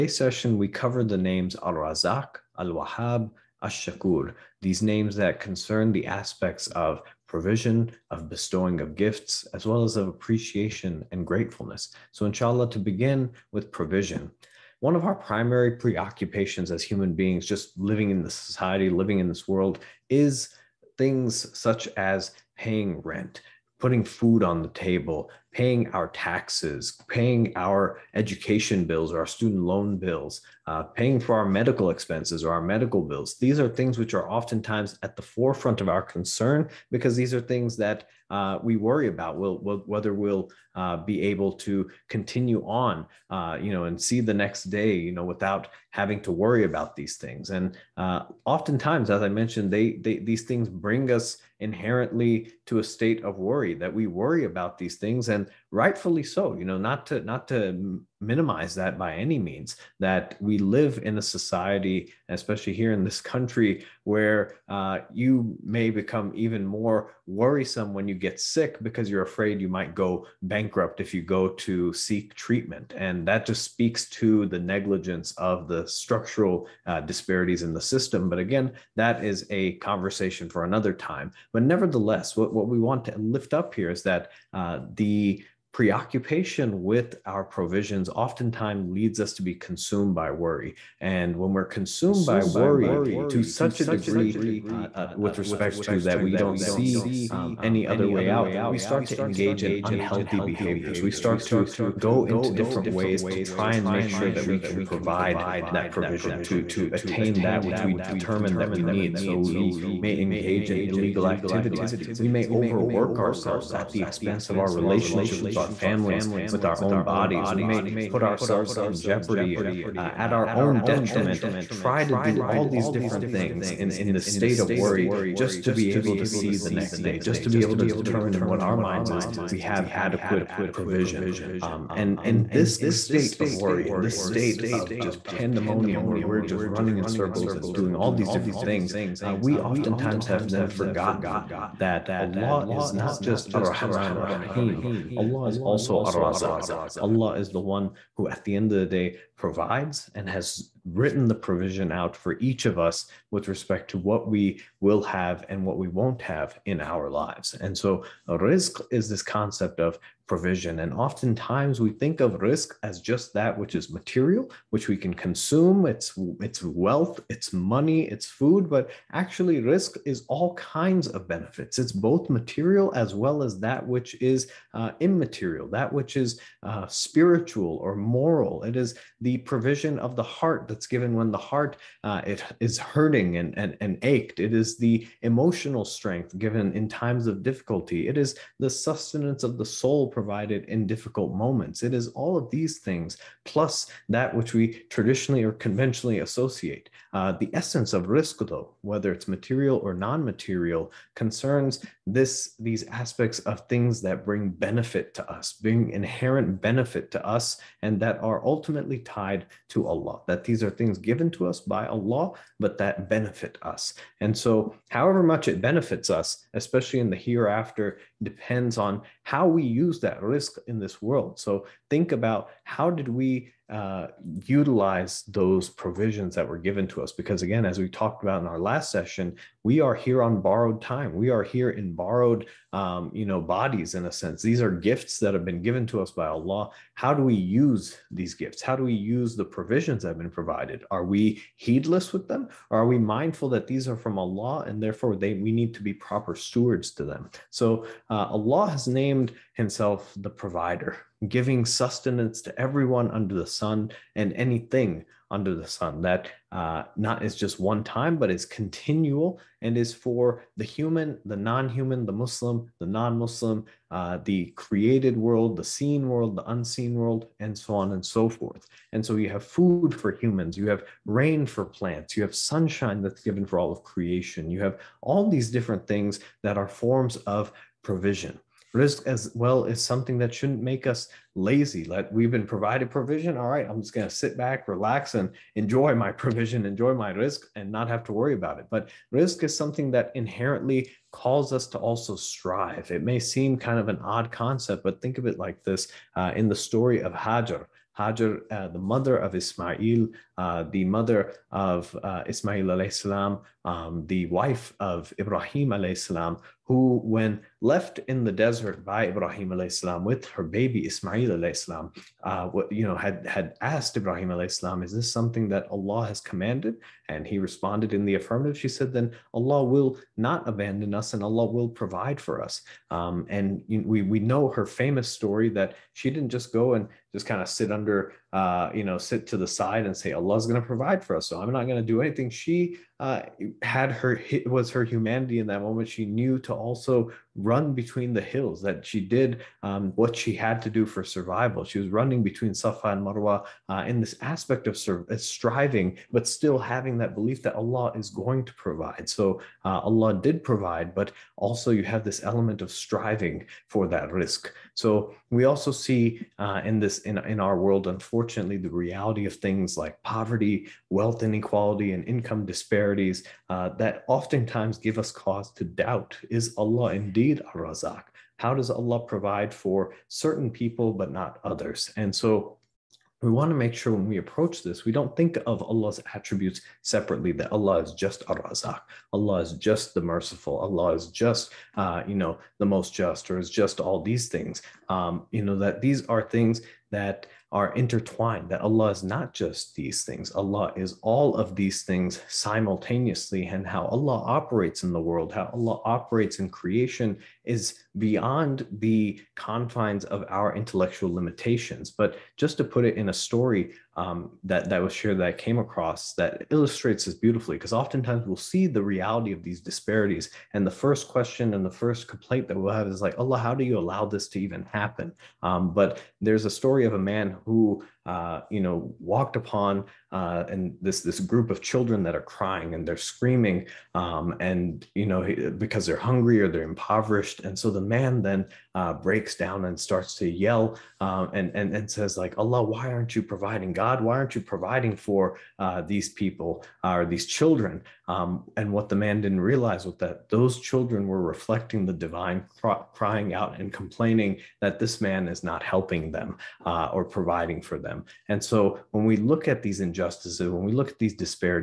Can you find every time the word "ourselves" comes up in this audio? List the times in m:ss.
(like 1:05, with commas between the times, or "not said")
1:53, 1:58.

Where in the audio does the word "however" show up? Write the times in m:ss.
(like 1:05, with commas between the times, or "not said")
3:34.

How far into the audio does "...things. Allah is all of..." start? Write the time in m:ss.
6:30.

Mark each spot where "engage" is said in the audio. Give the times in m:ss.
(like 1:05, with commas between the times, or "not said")
1:39, 1:50.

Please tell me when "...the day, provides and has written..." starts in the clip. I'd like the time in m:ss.
2:28.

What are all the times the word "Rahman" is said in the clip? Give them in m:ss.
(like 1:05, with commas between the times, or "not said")
2:23.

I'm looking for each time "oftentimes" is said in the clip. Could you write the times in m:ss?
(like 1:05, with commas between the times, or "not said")
0:34, 0:48, 1:28, 2:19, 2:40, 6:04, 6:47.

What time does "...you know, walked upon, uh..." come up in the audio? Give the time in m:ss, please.
6:58.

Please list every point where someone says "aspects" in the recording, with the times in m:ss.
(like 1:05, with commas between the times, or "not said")
0:06, 3:22, 5:44.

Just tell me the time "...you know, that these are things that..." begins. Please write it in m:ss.
6:25.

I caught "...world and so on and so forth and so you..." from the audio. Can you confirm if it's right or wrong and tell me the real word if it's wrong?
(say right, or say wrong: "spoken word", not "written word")
right.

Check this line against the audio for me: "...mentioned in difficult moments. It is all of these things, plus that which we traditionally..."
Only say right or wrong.
wrong.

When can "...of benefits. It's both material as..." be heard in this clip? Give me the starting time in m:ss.
2:51.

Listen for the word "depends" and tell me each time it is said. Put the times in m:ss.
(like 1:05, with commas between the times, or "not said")
3:38.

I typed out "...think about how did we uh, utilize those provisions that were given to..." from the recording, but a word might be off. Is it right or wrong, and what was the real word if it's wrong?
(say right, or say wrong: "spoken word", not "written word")
right.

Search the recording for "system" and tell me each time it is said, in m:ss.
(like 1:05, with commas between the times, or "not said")
1:17.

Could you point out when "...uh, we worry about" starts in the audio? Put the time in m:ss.
0:38.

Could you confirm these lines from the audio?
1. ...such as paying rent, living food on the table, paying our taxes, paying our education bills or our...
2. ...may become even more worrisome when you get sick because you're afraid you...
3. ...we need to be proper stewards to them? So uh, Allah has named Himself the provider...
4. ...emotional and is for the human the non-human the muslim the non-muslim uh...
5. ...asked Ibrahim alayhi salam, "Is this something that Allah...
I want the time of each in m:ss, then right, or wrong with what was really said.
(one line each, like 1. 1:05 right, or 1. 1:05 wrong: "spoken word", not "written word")
1. 0:21 wrong: "putting", not "living"
2. 1:05 right
3. 4:05 right
4. 4:18 wrong: "continual", not "emotional"
5. 5:13 right.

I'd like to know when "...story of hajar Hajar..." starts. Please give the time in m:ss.
4:56.